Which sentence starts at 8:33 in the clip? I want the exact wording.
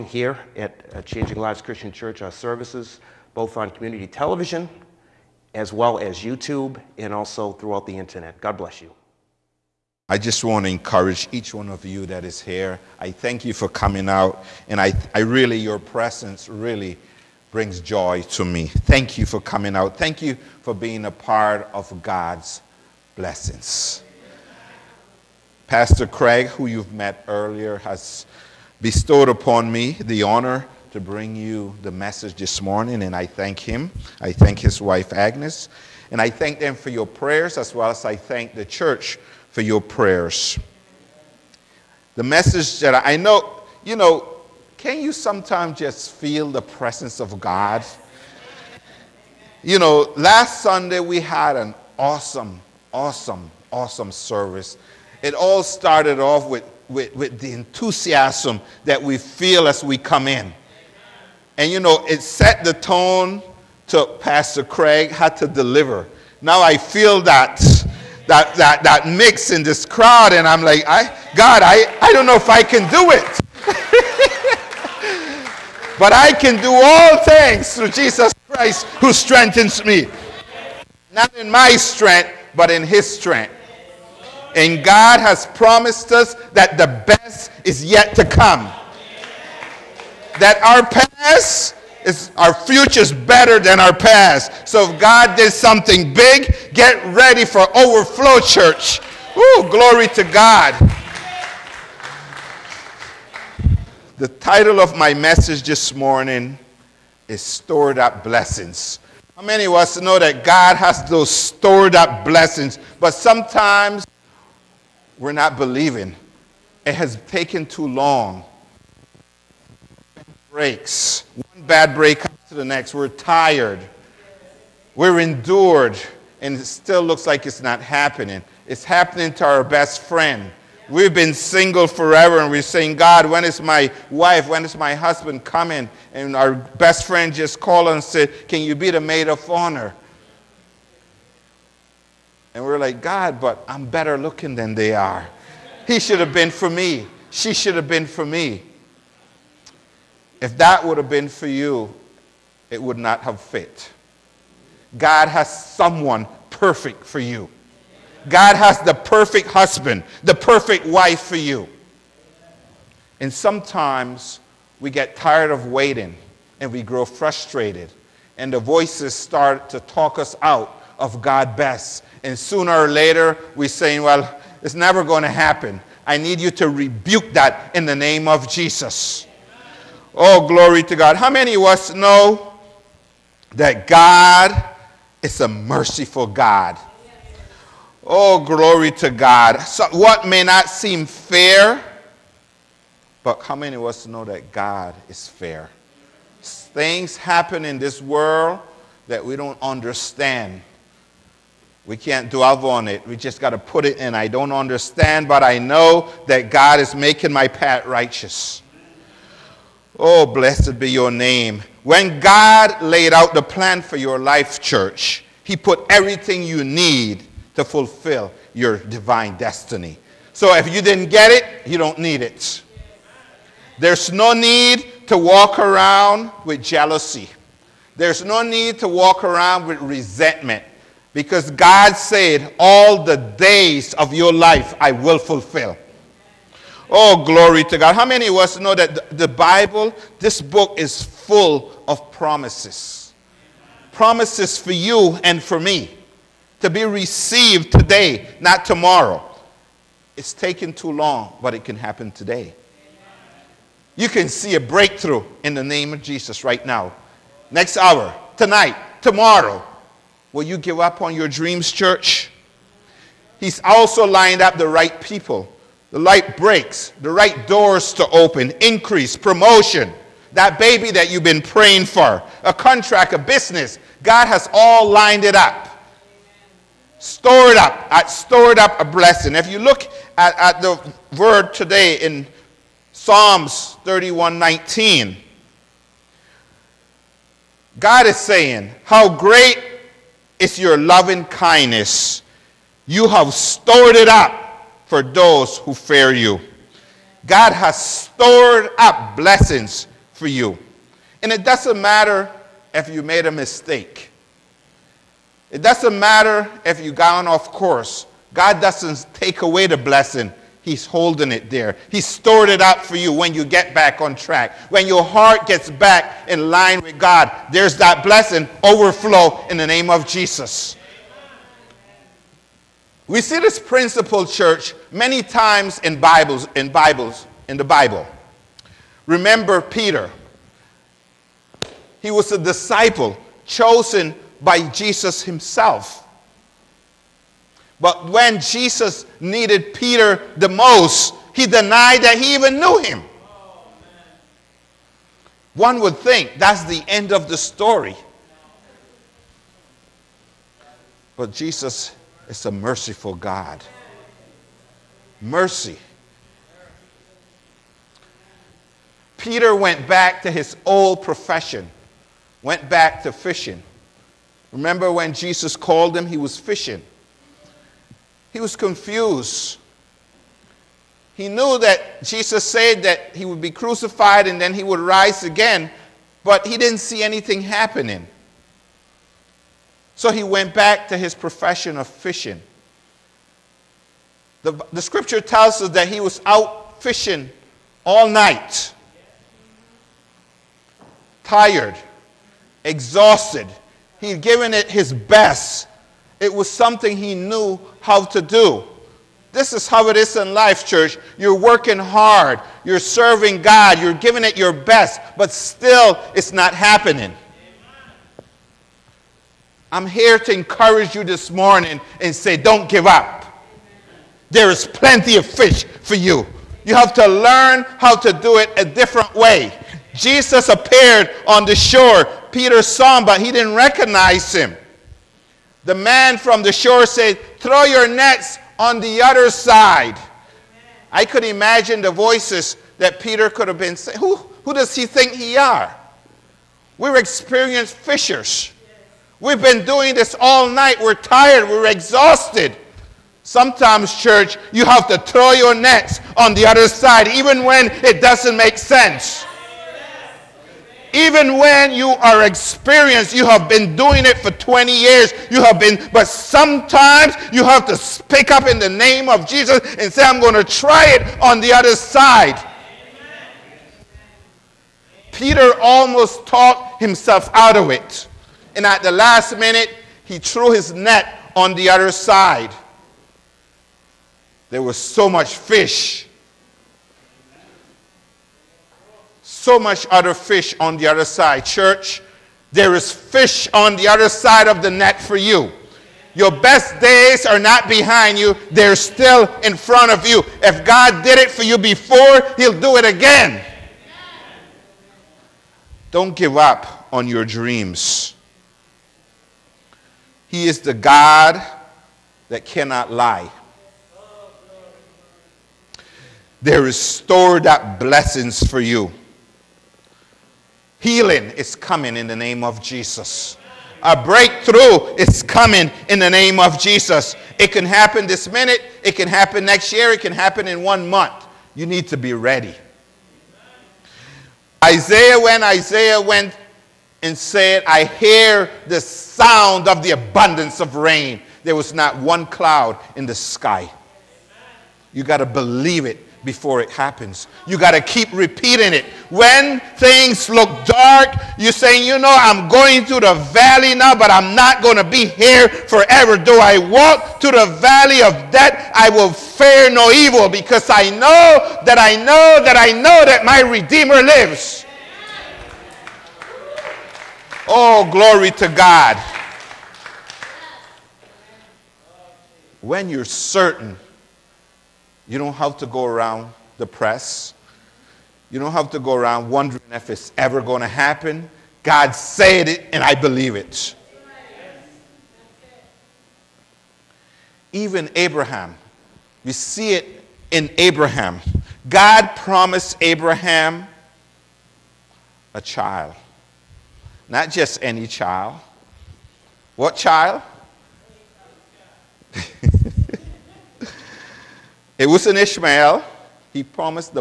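A breakthrough is coming in the name of Jesus.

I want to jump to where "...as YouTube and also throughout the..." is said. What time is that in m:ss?
0:05.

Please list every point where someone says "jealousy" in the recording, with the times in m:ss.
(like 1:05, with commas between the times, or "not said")
3:46.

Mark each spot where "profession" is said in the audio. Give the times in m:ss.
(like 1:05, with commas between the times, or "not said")
6:01, 6:21.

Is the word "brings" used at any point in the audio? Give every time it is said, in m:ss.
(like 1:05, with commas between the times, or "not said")
0:17, 0:31.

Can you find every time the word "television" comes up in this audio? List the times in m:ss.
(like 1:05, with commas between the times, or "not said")
0:04.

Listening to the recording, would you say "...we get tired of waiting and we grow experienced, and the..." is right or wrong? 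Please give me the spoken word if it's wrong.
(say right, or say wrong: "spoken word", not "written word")
wrong: "frustrated", not "experienced".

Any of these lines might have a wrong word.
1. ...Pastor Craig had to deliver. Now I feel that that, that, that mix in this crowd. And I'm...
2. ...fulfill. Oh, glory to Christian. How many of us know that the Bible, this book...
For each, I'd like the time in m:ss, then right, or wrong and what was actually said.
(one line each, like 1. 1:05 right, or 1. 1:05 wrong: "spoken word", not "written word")
1. 1:04 right
2. 3:55 wrong: "God", not "Christian".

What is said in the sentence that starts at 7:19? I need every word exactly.
We've been doing this all night.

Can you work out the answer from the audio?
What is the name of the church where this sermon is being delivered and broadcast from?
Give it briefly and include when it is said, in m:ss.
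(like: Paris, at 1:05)
Changing Lives Christian Church, at 0:01.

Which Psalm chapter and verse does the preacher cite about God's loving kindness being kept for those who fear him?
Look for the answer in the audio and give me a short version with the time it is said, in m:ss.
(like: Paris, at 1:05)
Psalms 31:19, at 4:42.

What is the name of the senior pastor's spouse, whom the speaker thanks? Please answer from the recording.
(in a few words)
Agnes.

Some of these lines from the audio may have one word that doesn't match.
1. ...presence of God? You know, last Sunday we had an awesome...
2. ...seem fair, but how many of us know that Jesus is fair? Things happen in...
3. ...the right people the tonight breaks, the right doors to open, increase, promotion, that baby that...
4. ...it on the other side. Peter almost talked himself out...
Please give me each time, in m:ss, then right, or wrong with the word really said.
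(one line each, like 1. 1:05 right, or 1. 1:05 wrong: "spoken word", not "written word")
1. 0:46 right
2. 3:10 wrong: "God", not "Jesus"
3. 4:24 wrong: "light", not "tonight"
4. 7:40 right.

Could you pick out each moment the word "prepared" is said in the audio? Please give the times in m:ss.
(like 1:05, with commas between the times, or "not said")
not said.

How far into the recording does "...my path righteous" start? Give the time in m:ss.
3:27.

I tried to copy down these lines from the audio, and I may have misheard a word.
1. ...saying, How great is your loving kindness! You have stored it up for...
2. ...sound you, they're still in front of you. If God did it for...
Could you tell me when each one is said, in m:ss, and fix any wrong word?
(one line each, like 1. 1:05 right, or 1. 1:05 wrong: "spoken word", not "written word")
1. 4:48 right
2. 8:07 wrong: "behind", not "sound".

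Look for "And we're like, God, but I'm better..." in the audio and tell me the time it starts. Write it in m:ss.
2:22.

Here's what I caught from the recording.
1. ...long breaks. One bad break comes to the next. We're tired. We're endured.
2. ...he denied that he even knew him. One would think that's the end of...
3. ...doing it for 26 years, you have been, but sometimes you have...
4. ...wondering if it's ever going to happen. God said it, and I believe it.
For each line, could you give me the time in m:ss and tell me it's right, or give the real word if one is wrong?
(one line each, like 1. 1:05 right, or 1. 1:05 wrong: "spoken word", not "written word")
1. 1:57 right
2. 5:41 right
3. 7:33 wrong: "20", not "26"
4. 9:29 right.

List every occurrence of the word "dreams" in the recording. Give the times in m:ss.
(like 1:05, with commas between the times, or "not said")
4:21, 8:17.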